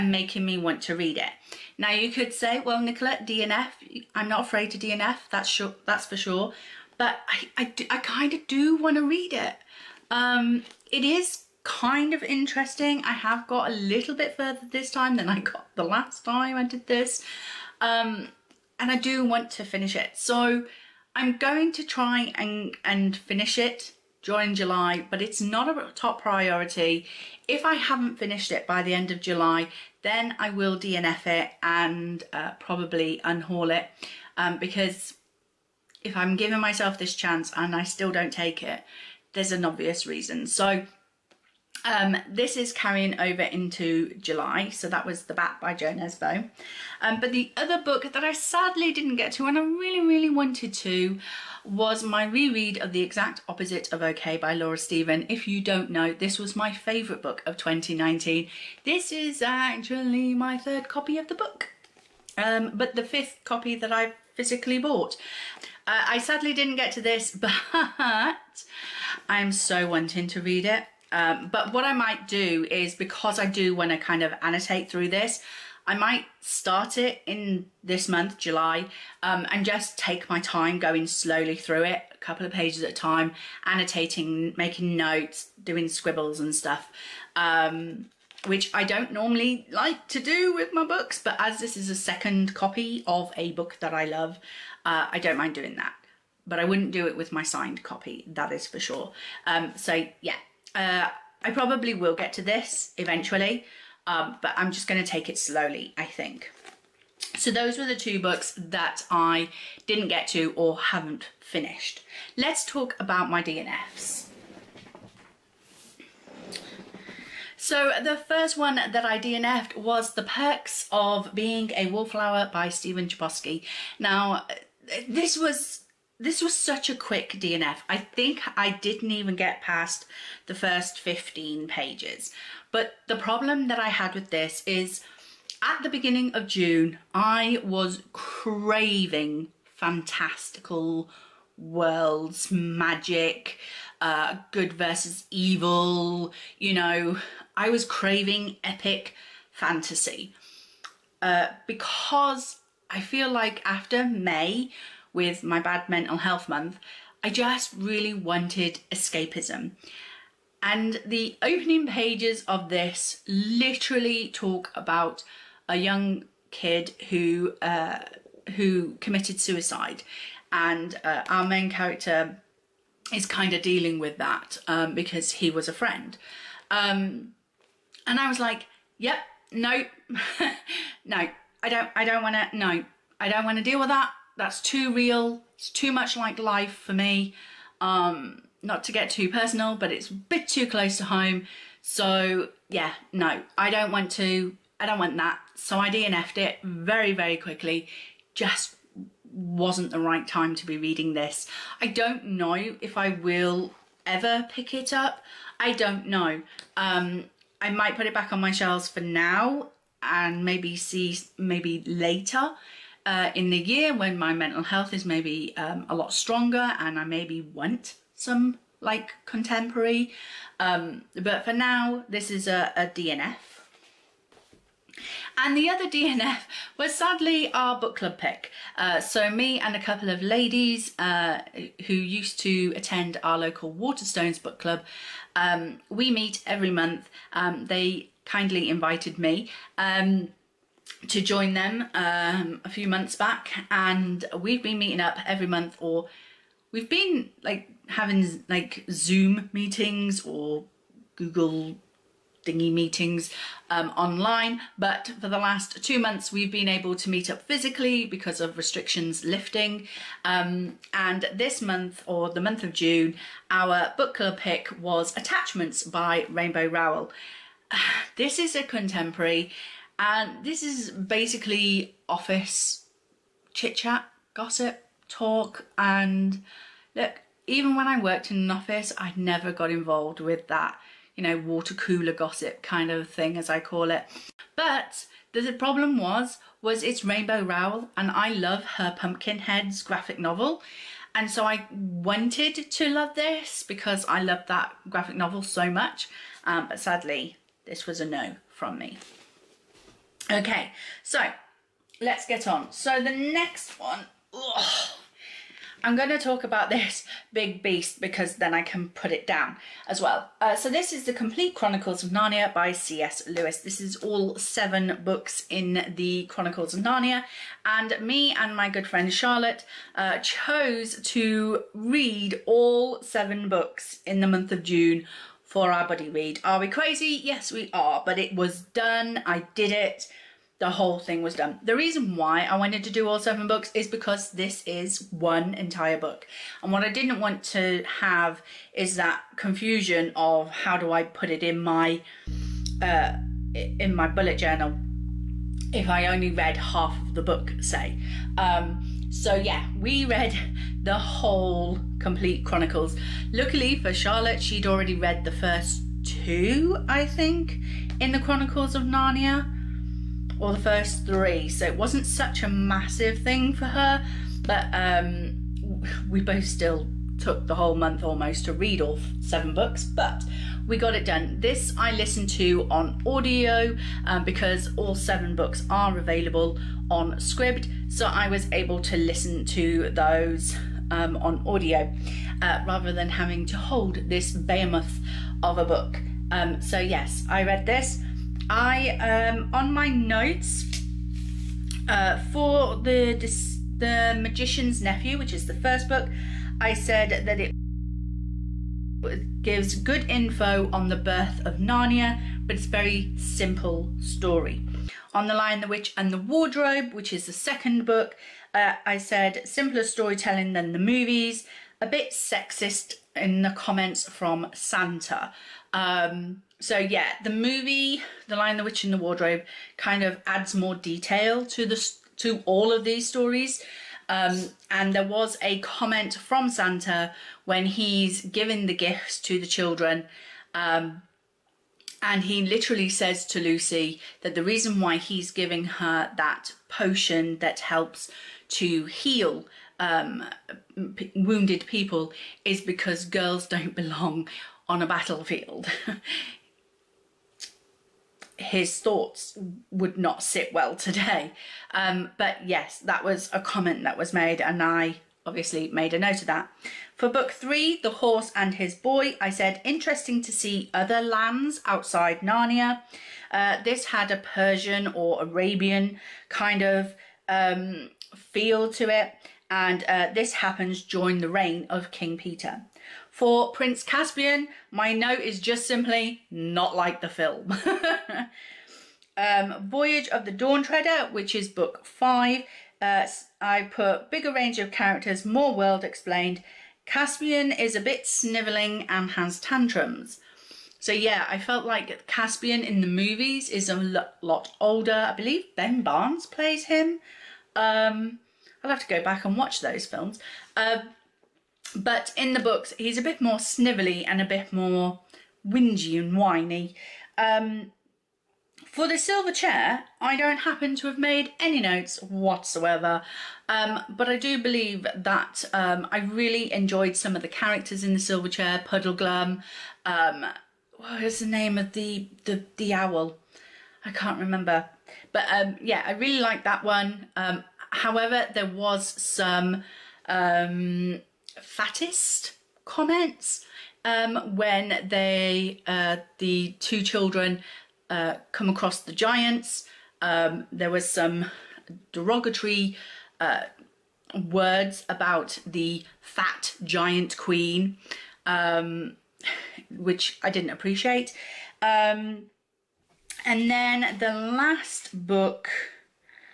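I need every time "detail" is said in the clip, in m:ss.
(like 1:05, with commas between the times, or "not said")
7:00.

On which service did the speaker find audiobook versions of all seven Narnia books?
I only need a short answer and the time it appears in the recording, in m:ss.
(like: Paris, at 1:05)
Scribd, at 6:17.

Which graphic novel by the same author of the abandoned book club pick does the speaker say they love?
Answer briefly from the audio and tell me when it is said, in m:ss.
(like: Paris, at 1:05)
Pumpkinheads, at 4:48.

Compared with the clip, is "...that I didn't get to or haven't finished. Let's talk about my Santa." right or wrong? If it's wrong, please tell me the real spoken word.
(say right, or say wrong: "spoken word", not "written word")
wrong: "DNFs", not "Santa".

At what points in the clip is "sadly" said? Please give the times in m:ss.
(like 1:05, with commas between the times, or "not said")
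0:48, 1:06, 3:46, 4:56.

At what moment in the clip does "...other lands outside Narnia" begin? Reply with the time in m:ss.
7:40.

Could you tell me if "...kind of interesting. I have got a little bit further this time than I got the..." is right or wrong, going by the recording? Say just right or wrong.
right.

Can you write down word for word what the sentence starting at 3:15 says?
So I DNF'd it very, very quickly.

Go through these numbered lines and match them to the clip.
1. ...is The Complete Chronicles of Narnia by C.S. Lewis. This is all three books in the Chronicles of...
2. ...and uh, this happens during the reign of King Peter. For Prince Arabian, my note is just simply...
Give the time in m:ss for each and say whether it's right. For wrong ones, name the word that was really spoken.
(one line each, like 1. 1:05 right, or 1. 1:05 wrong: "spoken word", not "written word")
1. 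5:10 wrong: "seven", not "three"
2. 7:49 wrong: "Caspian", not "Arabian".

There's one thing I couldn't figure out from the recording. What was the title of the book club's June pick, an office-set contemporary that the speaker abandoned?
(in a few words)
Attachments.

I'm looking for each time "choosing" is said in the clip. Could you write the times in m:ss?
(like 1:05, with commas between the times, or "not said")
not said.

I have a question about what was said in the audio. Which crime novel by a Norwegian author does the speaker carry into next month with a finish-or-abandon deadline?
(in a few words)
The Bat.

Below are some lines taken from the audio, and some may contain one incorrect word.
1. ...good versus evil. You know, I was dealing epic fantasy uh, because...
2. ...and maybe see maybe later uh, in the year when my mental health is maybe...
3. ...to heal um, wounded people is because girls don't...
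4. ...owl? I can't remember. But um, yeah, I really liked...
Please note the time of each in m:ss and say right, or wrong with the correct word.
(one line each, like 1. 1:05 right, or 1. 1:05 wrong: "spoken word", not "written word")
1. 2:24 wrong: "craving", not "dealing"
2. 3:30 right
3. 7:18 right
4. 8:42 right.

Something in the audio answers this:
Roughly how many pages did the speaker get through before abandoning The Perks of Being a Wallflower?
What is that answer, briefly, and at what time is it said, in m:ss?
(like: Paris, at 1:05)
15, at 2:10.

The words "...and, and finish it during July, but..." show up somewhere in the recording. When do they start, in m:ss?
0:22.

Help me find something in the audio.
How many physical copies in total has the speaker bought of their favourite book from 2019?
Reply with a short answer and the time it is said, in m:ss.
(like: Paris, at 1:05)
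5, at 1:03.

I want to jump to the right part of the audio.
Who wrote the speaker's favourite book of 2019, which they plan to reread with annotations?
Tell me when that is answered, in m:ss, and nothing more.
0:54.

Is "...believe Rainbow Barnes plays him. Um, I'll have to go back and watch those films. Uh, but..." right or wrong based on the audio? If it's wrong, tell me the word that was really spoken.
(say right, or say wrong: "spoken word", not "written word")
wrong: "Ben", not "Rainbow".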